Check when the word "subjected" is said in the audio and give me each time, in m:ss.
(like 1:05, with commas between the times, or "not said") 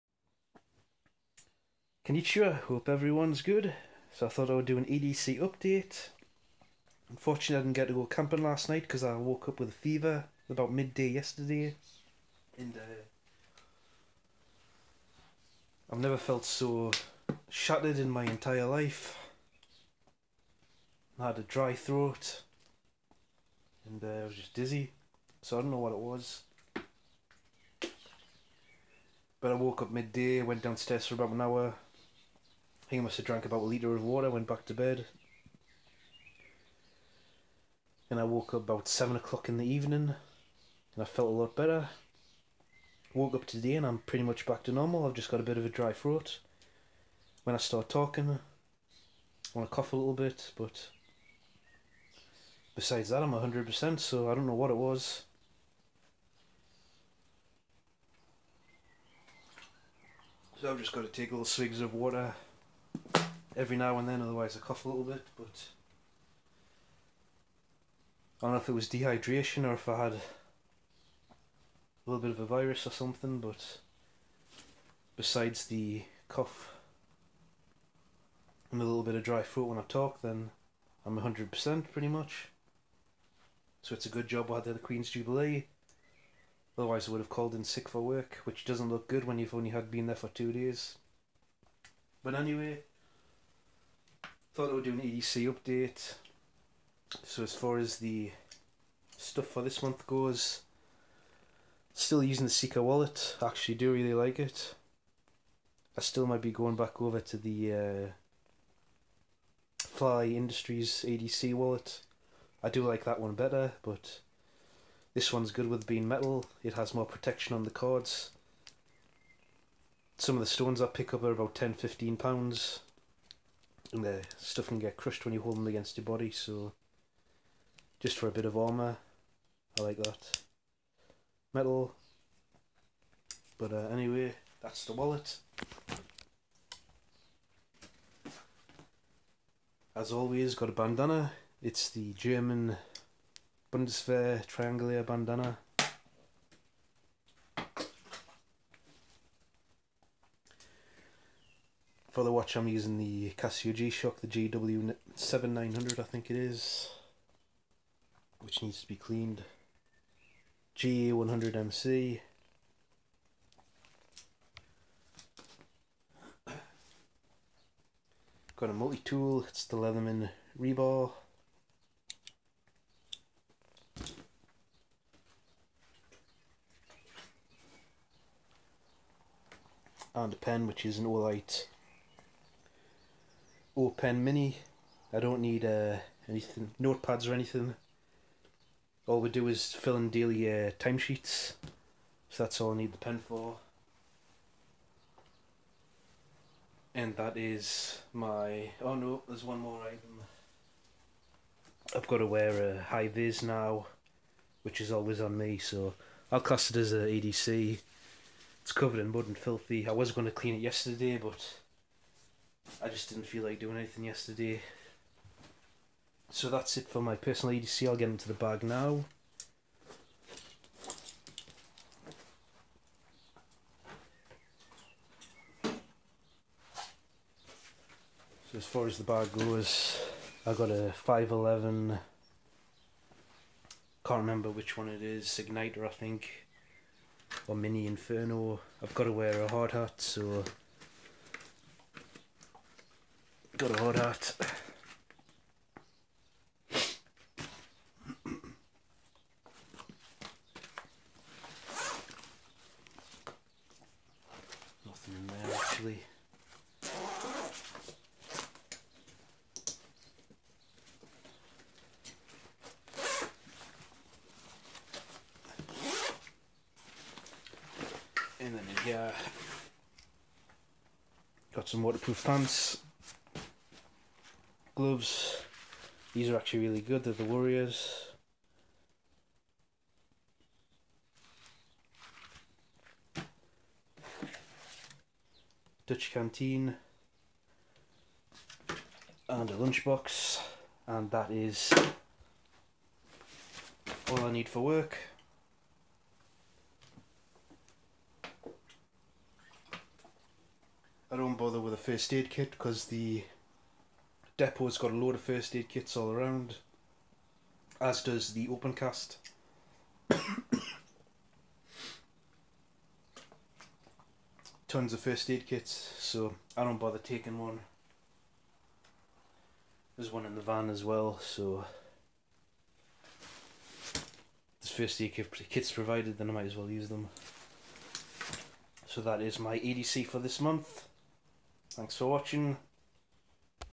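not said.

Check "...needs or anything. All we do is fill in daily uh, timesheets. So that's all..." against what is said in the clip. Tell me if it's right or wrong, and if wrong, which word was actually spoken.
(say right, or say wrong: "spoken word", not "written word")
wrong: "notepads", not "needs".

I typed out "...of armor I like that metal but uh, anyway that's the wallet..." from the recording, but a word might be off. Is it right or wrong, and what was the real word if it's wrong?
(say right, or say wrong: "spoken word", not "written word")
right.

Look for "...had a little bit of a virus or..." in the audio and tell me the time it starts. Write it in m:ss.
1:10.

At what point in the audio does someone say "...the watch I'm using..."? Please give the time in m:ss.
2:32.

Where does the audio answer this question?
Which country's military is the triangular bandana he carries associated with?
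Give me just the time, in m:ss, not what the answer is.
2:22.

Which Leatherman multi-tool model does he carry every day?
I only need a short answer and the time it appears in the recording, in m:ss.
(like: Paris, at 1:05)
Rebar, at 2:49.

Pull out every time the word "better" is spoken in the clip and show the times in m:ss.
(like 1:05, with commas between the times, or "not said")
0:41, 1:53.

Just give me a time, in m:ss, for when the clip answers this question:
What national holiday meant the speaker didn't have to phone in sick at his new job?
1:24.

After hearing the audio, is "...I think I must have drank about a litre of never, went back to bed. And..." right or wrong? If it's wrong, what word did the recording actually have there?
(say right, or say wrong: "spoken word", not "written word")
wrong: "water", not "never".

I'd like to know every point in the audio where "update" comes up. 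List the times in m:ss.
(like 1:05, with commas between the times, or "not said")
0:05, 1:35.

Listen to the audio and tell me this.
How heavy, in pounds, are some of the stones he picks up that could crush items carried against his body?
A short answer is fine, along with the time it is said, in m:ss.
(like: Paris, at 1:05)
10-15 pounds, at 2:01.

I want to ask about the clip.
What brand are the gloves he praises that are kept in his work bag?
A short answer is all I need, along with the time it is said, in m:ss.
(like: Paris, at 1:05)
Warriors, at 4:37.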